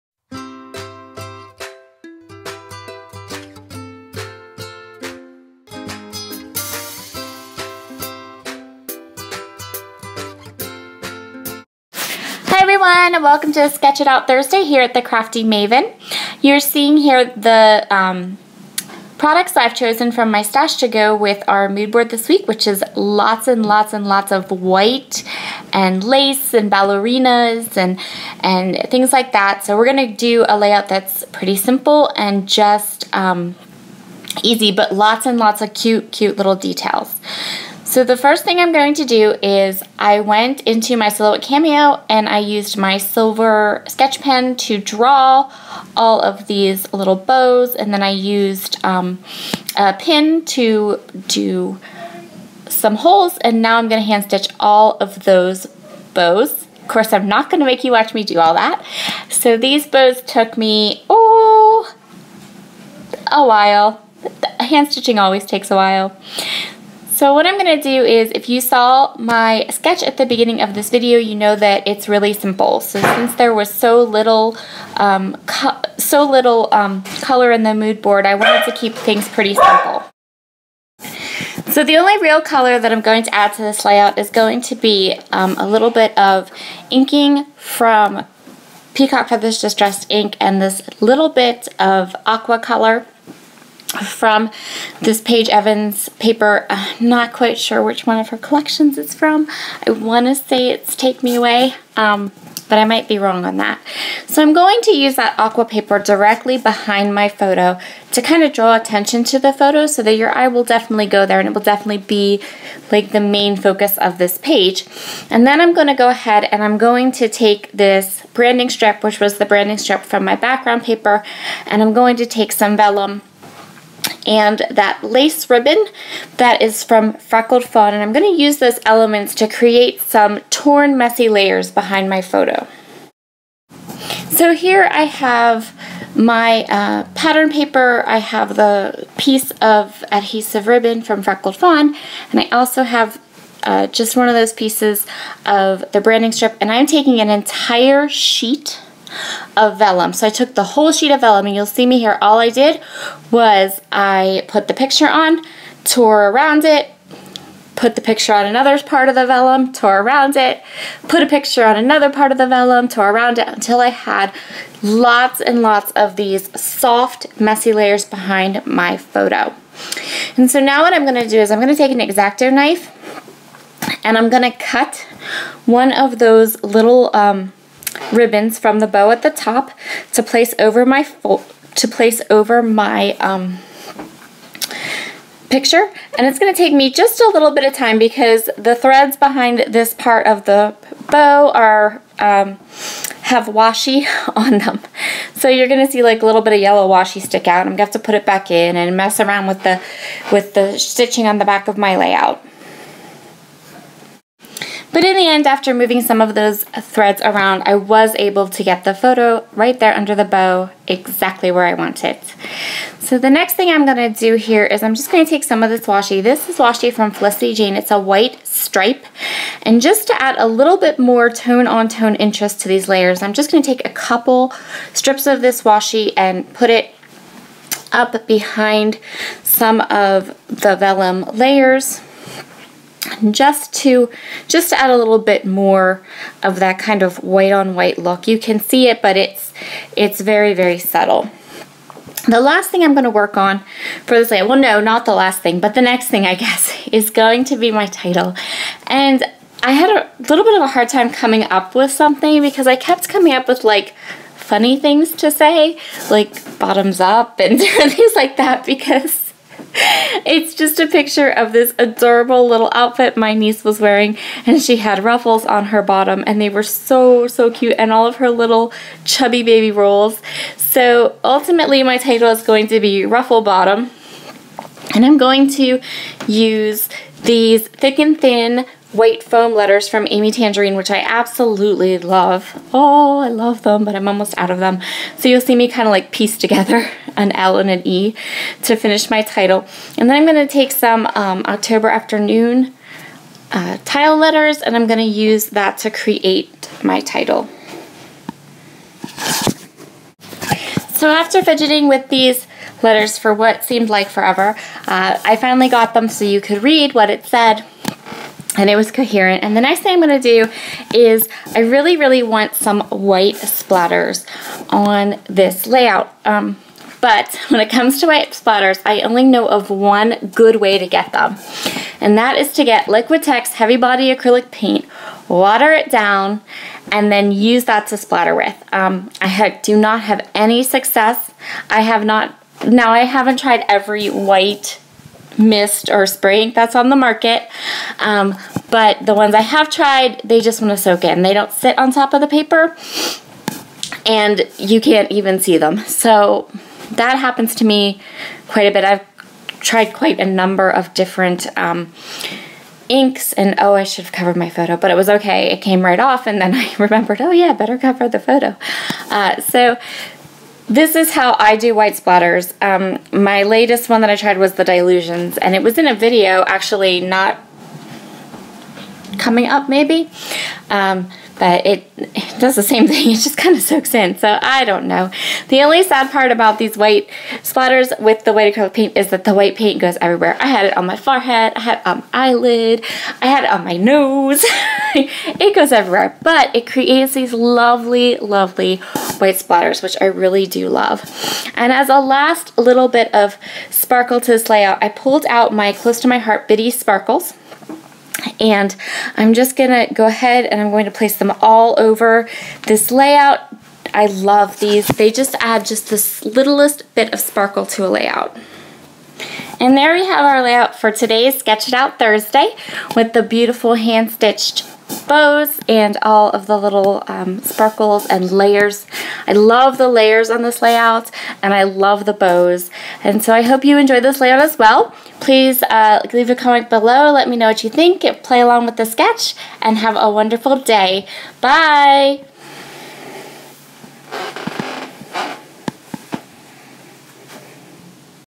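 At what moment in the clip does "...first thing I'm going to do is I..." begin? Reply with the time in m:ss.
0:38.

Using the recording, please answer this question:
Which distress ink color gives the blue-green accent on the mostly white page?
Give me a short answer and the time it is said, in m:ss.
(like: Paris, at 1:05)
Peacock Feathers, at 1:28.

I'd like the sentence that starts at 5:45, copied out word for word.
So that happens to me quite a bit.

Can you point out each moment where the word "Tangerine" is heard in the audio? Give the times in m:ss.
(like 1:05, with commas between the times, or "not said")
4:40.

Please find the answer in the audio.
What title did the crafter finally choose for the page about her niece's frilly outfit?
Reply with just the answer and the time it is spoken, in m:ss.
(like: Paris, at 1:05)
Ruffle Bottom, at 4:33.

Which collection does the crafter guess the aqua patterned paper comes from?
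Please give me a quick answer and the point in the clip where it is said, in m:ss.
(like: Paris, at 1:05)
Take Me Away, at 1:40.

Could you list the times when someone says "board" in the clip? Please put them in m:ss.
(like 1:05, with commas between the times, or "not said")
0:21, 1:18.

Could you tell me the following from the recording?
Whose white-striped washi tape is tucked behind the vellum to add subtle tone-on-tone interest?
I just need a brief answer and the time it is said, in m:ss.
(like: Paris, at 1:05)
Felicity Jane, at 3:37.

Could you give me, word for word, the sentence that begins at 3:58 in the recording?
You can see it, but it's it's very, very subtle.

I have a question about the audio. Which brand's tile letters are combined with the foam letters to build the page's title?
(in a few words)
October Afternoon.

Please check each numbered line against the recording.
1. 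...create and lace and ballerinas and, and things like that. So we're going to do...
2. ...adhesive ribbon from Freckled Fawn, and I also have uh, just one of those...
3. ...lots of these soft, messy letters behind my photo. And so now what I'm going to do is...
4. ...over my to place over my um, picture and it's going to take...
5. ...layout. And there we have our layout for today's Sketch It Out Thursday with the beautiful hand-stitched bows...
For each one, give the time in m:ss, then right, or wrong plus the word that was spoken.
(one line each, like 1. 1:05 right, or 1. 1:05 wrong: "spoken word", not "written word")
1. 0:24 wrong: "white", not "create"
2. 2:20 right
3. 2:45 wrong: "layers", not "letters"
4. 3:00 right
5. 6:47 right.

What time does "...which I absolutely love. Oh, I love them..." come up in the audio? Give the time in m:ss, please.
4:40.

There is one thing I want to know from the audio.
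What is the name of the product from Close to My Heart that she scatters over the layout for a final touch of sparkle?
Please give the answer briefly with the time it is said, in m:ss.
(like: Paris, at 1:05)
Bitty Sparkles, at 6:36.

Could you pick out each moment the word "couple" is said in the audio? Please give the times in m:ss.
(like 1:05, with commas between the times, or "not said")
3:43.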